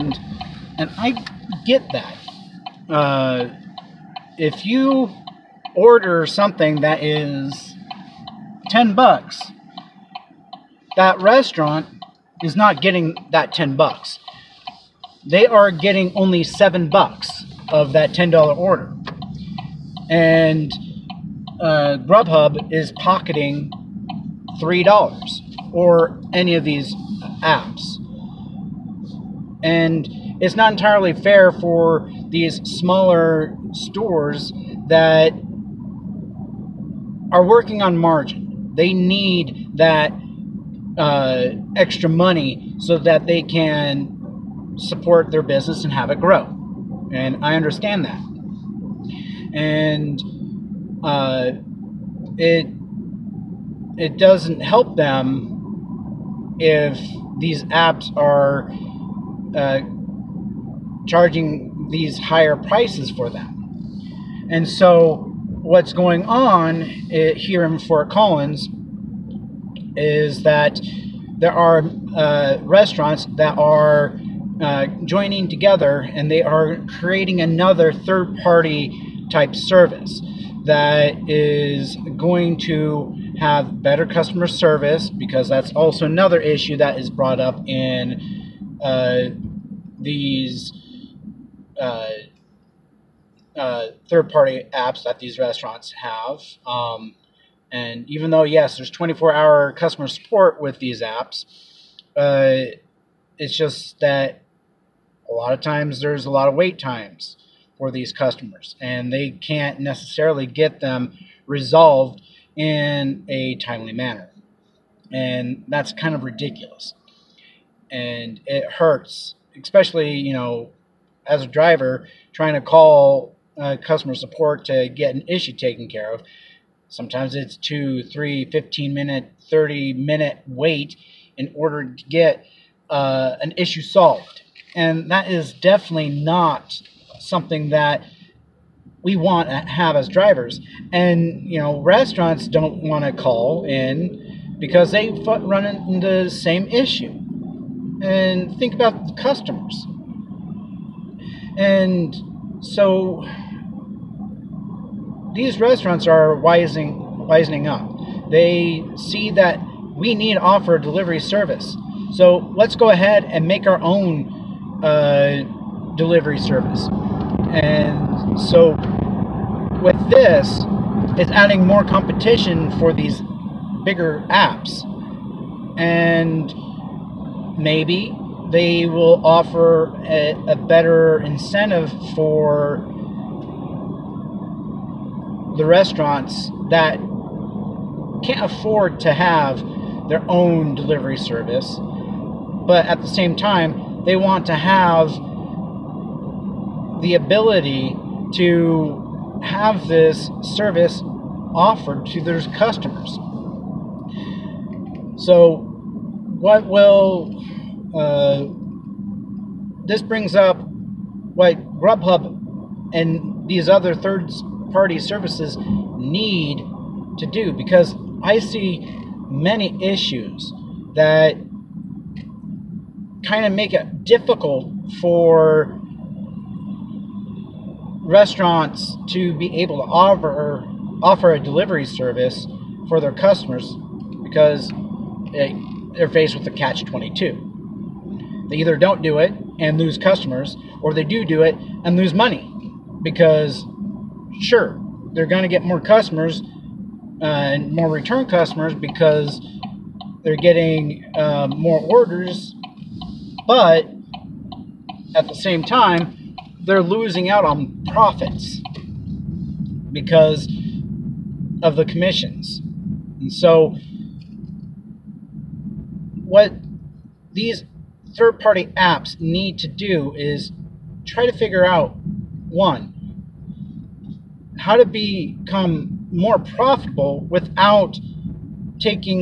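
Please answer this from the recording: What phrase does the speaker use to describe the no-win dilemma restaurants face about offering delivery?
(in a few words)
catch 22.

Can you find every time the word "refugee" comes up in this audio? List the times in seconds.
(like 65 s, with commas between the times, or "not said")
not said.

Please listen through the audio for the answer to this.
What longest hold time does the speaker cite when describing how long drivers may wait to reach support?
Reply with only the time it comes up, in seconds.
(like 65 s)
129 s.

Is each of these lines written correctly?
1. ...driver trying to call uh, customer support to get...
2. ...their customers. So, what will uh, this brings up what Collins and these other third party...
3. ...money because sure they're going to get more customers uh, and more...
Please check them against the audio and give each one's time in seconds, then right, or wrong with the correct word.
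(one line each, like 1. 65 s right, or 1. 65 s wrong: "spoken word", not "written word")
1. 121 s right
2. 202 s wrong: "Grubhub", not "Collins"
3. 242 s right.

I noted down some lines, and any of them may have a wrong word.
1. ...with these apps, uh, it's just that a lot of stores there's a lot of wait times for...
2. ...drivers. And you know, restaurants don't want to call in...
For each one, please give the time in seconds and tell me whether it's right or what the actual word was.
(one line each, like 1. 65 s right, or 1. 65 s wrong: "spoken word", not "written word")
1. 100 s wrong: "times", not "stores"
2. 140 s right.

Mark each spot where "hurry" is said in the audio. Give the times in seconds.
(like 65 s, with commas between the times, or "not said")
not said.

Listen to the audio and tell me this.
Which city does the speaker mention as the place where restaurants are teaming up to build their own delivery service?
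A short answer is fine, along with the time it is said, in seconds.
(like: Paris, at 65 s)
Fort Collins, at 67 s.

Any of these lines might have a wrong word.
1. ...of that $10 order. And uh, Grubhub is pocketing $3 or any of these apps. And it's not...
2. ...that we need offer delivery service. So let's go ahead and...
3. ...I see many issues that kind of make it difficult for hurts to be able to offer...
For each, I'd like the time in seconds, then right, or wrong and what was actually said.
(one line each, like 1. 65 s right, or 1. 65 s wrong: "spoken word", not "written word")
1. 17 s right
2. 159 s right
3. 218 s wrong: "restaurants", not "hurts".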